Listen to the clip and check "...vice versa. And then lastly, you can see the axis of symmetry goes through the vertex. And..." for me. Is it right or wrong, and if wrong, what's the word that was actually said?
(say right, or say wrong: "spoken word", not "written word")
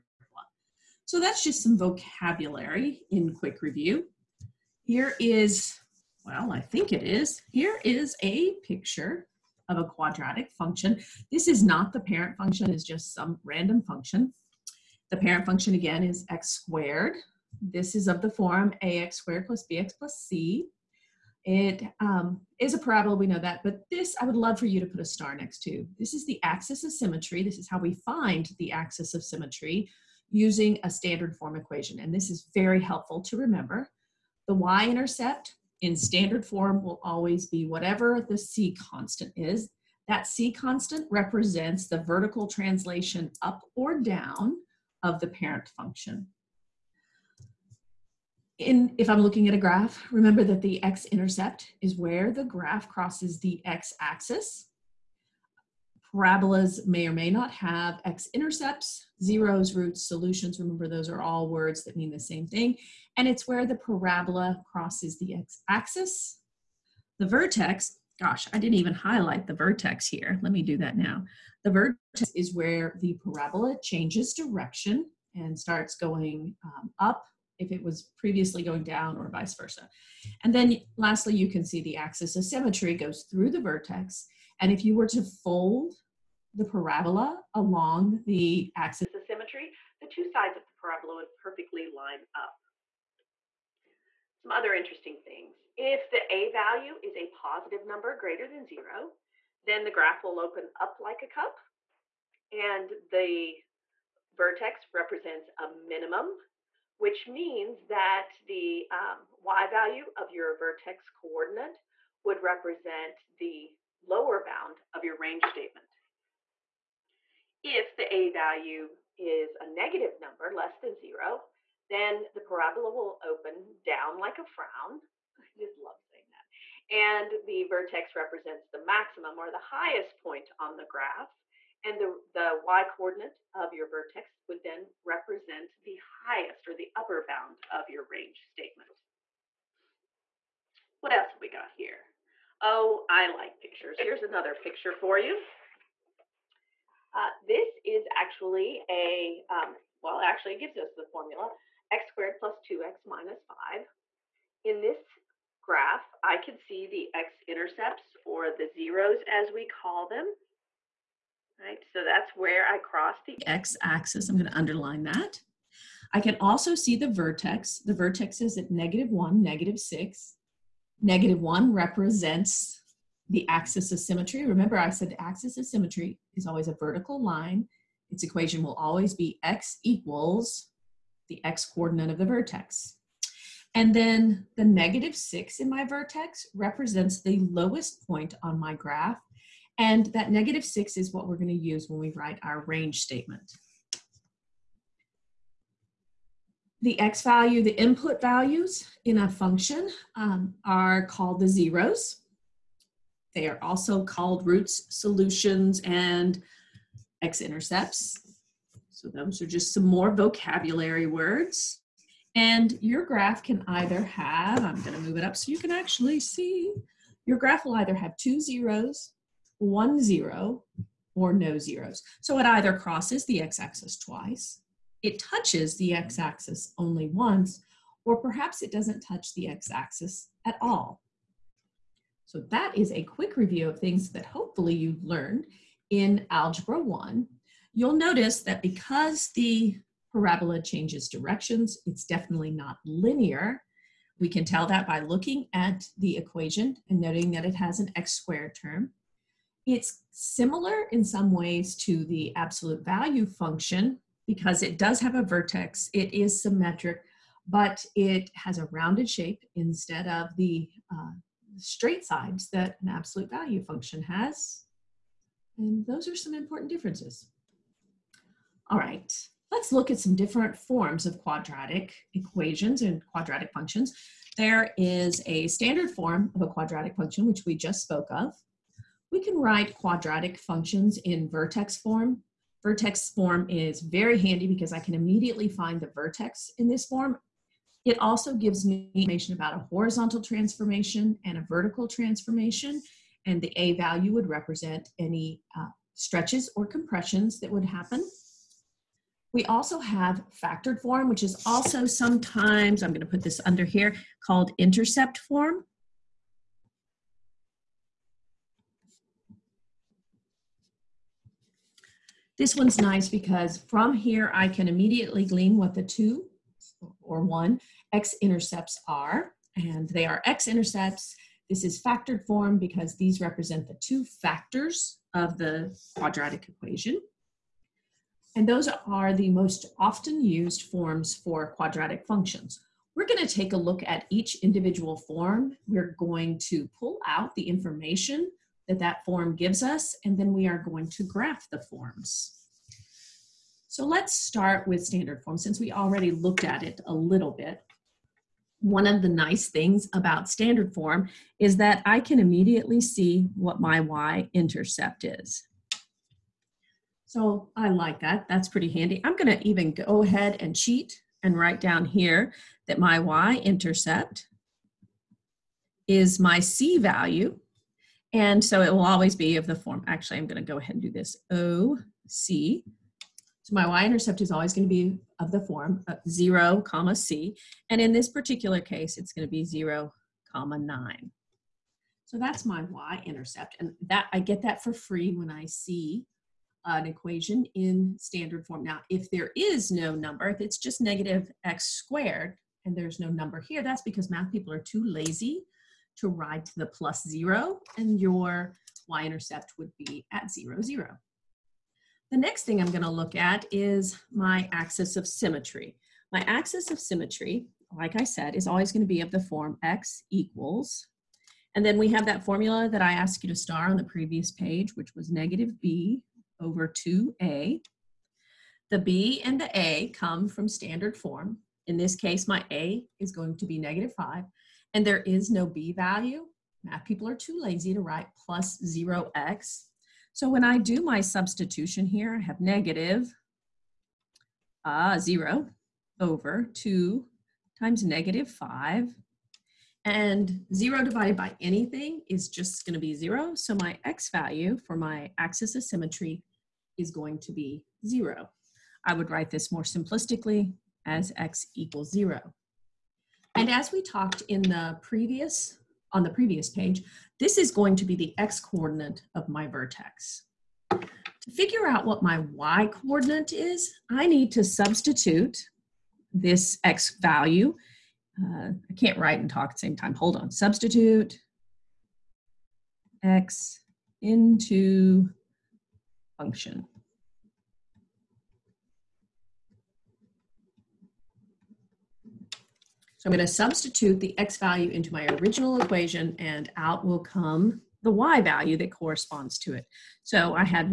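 right.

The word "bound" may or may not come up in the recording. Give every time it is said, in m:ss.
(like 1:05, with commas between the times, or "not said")
1:54, 2:17.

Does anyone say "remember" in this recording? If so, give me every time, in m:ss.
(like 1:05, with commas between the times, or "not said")
0:33, 0:50, 1:00, 2:54.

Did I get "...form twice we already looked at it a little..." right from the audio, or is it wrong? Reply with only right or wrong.
wrong.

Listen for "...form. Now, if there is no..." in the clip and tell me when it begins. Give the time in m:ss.
6:28.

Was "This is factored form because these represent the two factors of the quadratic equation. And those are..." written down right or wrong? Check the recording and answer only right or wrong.
right.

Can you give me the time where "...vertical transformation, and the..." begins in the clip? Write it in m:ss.
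4:51.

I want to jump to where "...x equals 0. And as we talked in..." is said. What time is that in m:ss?
7:31.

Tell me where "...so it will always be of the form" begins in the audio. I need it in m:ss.
6:08.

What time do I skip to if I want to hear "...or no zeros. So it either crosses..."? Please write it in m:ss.
3:41.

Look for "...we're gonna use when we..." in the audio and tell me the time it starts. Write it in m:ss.
3:11.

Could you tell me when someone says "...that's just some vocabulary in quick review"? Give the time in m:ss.
0:01.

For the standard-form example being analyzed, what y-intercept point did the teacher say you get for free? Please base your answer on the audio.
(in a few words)
(0, 9).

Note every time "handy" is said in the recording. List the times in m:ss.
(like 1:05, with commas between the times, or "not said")
4:44, 5:58.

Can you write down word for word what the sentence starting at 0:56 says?
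Parabolas may or may not have x-intercepts, zeros, roots, solutions.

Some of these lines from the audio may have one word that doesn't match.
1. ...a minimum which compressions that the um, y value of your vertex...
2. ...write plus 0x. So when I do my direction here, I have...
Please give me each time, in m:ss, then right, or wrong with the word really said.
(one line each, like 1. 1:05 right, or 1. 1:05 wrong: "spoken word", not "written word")
1. 1:45 wrong: "means", not "compressions"
2. 7:07 wrong: "substitution", not "direction".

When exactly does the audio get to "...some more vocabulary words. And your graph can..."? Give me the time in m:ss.
3:29.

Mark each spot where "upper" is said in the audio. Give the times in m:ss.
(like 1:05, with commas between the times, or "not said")
2:16.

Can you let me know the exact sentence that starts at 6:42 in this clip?
The next thing I'm gonna look at is my axis of symmetry.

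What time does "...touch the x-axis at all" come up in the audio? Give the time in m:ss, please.
3:49.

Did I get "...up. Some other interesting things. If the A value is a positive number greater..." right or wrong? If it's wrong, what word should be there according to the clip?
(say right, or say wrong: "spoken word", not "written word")
right.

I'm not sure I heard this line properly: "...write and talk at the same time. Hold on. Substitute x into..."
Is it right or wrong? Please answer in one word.
right.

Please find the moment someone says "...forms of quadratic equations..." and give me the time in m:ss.
4:30.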